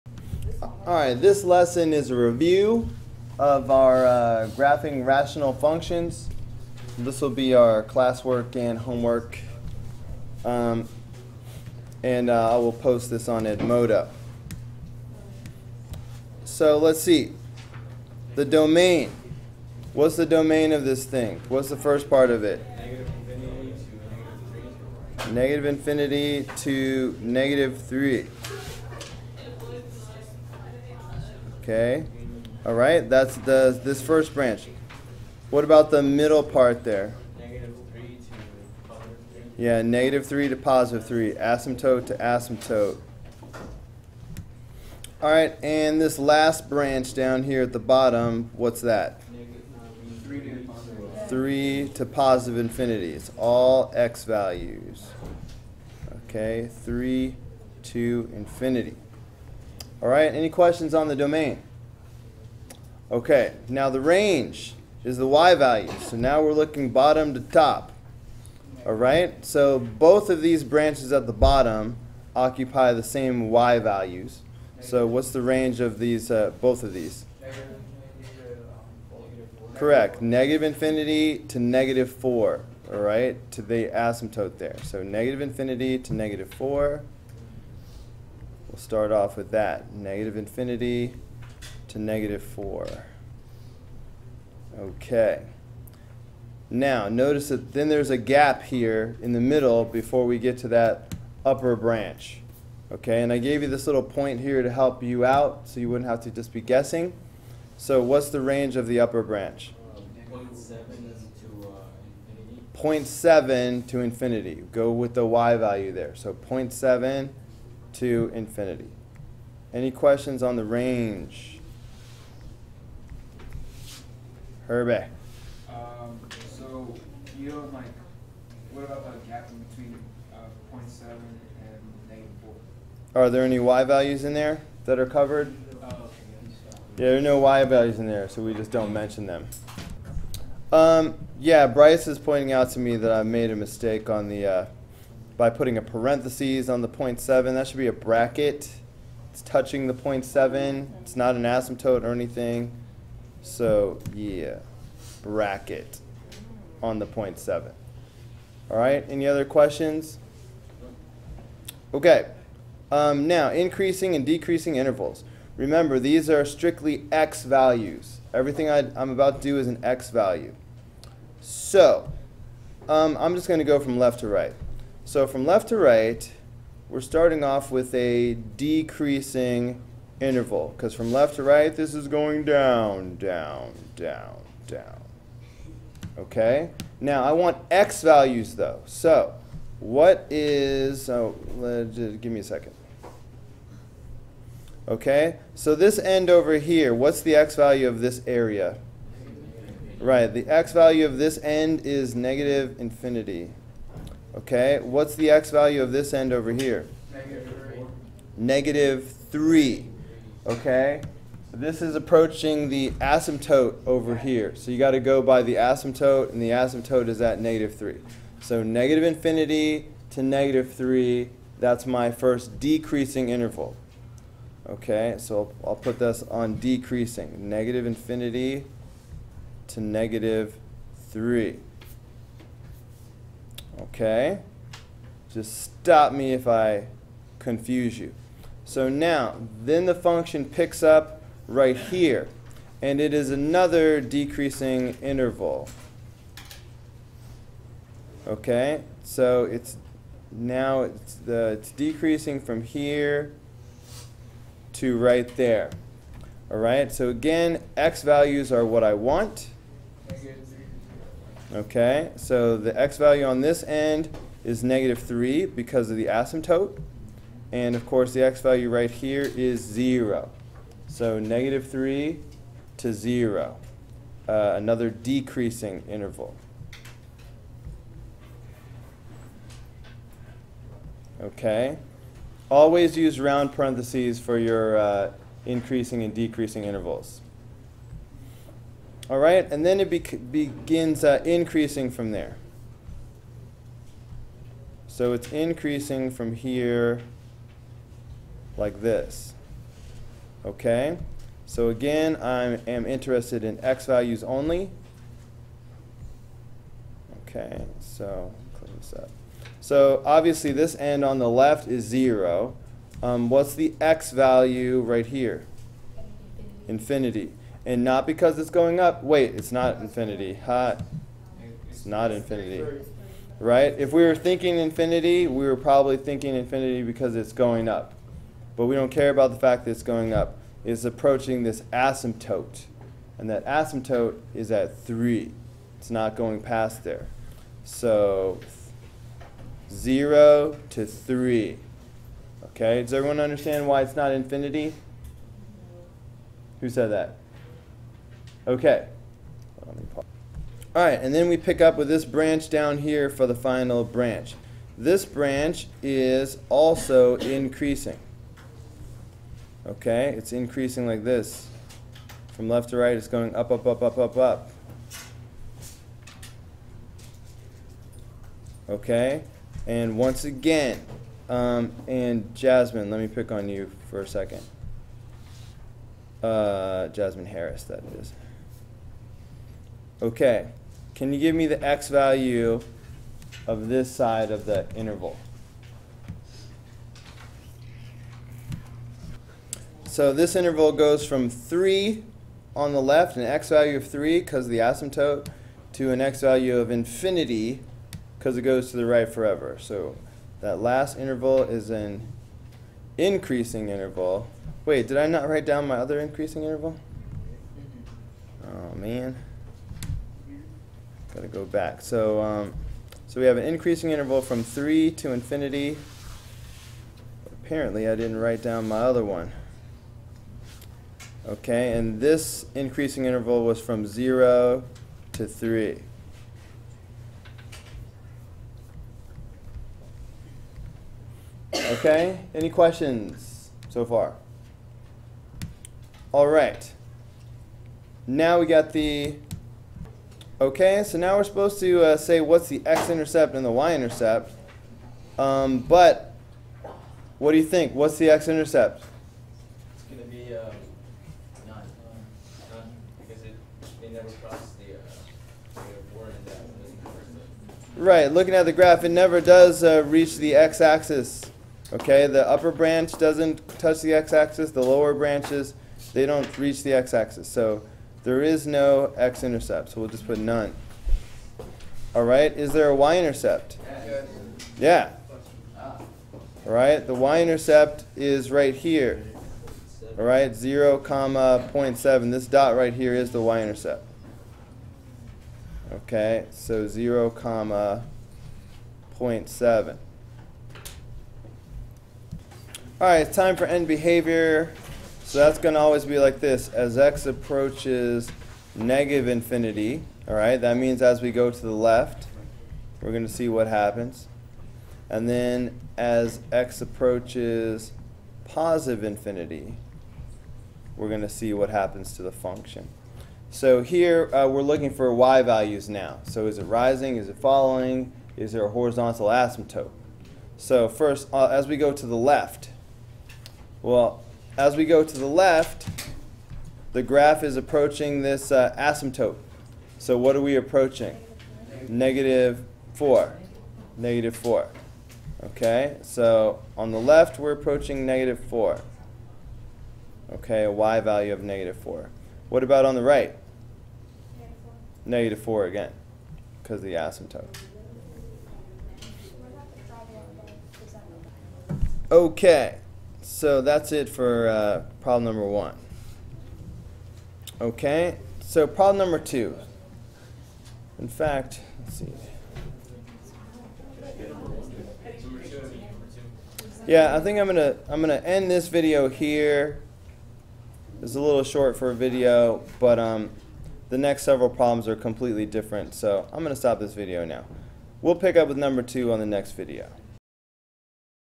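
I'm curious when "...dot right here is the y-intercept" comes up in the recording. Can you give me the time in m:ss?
8:02.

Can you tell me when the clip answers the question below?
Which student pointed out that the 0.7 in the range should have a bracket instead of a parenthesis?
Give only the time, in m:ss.
2:21.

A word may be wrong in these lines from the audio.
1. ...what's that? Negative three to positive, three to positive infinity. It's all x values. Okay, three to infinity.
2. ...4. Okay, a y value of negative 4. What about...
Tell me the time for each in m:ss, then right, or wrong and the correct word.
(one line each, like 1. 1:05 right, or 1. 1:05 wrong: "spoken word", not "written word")
1. 0:48 right
2. 8:58 right.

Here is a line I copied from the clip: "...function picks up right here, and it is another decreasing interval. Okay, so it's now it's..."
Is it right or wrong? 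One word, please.
right.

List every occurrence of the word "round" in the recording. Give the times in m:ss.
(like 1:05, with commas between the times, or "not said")
4:43.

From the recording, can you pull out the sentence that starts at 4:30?
So negative 3 to 0, uh, another decreasing interval.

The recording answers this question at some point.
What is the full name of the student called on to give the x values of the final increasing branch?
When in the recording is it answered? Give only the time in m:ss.
6:16.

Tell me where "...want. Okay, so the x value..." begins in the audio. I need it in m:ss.
4:18.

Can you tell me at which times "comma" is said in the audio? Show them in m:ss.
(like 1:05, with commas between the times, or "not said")
8:00, 8:07.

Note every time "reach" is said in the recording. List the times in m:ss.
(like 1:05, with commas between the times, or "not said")
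7:39, 7:46.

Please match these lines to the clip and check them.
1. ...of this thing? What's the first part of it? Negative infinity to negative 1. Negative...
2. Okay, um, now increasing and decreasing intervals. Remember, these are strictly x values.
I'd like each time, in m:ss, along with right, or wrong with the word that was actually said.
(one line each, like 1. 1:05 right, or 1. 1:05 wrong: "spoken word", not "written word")
1. 0:20 wrong: "3", not "1"
2. 2:41 right.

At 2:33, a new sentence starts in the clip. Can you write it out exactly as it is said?
So yeah, bracket on the 0.7.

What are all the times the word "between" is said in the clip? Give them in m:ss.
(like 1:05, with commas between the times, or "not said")
2:09.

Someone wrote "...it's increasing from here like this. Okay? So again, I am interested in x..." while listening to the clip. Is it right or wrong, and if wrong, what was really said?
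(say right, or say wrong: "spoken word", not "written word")
right.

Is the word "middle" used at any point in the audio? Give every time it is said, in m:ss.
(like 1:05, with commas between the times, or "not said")
0:36, 1:39.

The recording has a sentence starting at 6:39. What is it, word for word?
So that last interval is an increasing interval.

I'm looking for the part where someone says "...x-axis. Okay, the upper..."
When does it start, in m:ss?
7:40.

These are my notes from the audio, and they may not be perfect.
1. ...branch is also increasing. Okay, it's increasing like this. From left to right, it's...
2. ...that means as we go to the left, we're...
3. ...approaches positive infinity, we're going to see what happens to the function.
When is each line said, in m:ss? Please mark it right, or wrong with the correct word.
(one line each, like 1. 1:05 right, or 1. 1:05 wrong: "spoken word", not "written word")
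1. 5:55 right
2. 8:20 right
3. 8:26 right.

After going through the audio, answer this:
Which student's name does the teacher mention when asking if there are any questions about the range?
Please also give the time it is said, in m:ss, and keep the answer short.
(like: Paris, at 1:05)
Herbe, at 2:04.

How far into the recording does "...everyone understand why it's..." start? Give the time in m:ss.
5:42.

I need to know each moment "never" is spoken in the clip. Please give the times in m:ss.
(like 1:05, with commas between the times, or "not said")
7:33, 7:38.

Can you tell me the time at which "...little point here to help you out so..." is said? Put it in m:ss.
1:43.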